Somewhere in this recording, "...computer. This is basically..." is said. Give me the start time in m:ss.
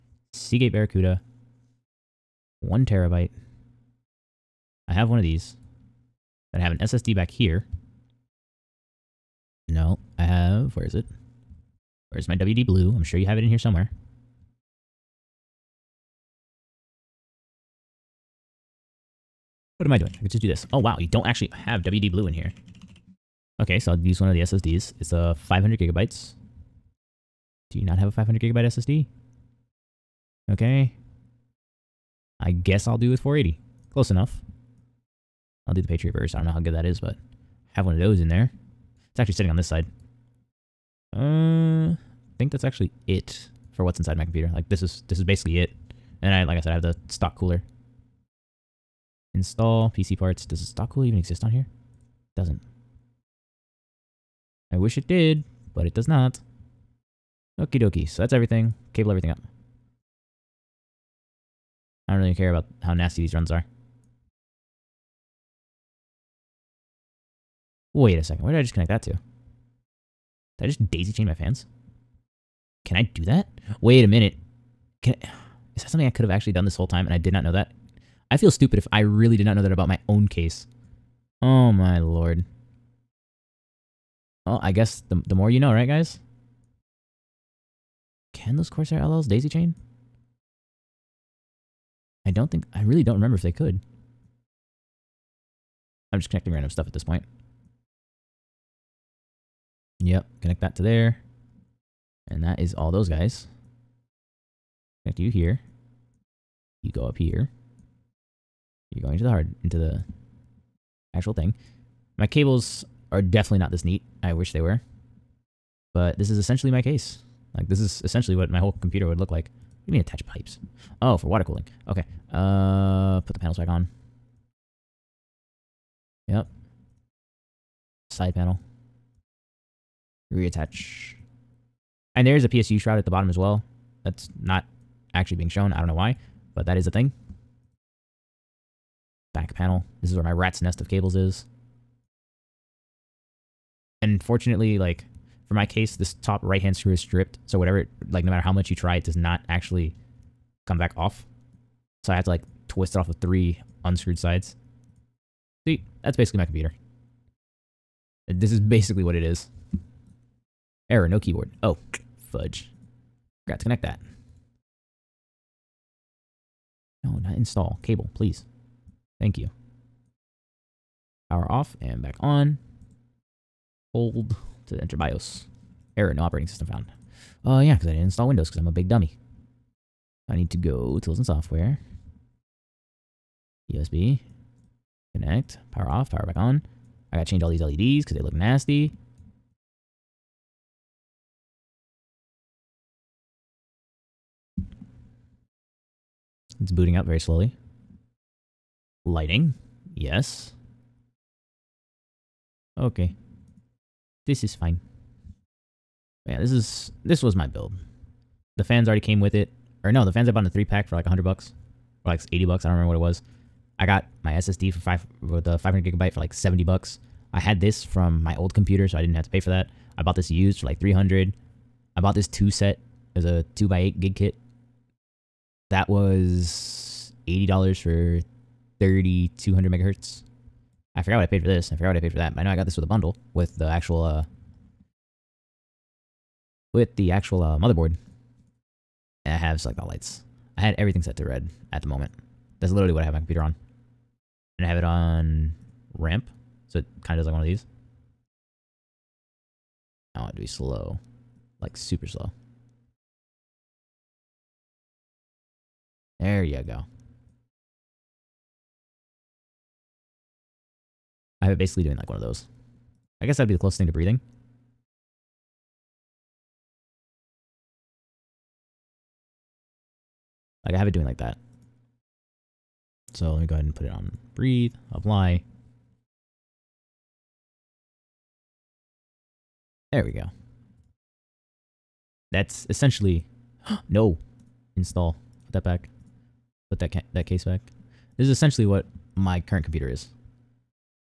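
2:36.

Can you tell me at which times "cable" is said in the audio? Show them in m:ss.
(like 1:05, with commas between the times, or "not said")
0:58, 1:52, 2:20, 2:47.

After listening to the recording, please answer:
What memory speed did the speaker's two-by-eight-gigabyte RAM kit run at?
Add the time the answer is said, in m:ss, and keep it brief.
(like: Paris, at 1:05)
3200 megahertz, at 3:48.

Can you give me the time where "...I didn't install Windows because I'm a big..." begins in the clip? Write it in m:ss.
2:57.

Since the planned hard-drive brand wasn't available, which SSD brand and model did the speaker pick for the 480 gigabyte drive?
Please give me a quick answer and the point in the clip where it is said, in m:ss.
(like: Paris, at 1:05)
Patriot Burst, at 0:35.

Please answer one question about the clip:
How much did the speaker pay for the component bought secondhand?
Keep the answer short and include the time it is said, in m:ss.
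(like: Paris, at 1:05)
300, at 3:40.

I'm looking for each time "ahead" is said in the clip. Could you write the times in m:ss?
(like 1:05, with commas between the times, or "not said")
4:33.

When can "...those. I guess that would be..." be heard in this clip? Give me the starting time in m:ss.
4:22.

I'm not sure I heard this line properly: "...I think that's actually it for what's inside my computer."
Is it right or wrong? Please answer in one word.
right.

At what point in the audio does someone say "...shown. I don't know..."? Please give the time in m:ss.
2:15.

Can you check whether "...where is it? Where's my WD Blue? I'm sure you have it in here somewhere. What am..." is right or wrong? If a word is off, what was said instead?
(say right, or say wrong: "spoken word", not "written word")
right.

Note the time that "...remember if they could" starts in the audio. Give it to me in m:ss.
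1:33.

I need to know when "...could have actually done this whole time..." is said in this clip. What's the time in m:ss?
1:16.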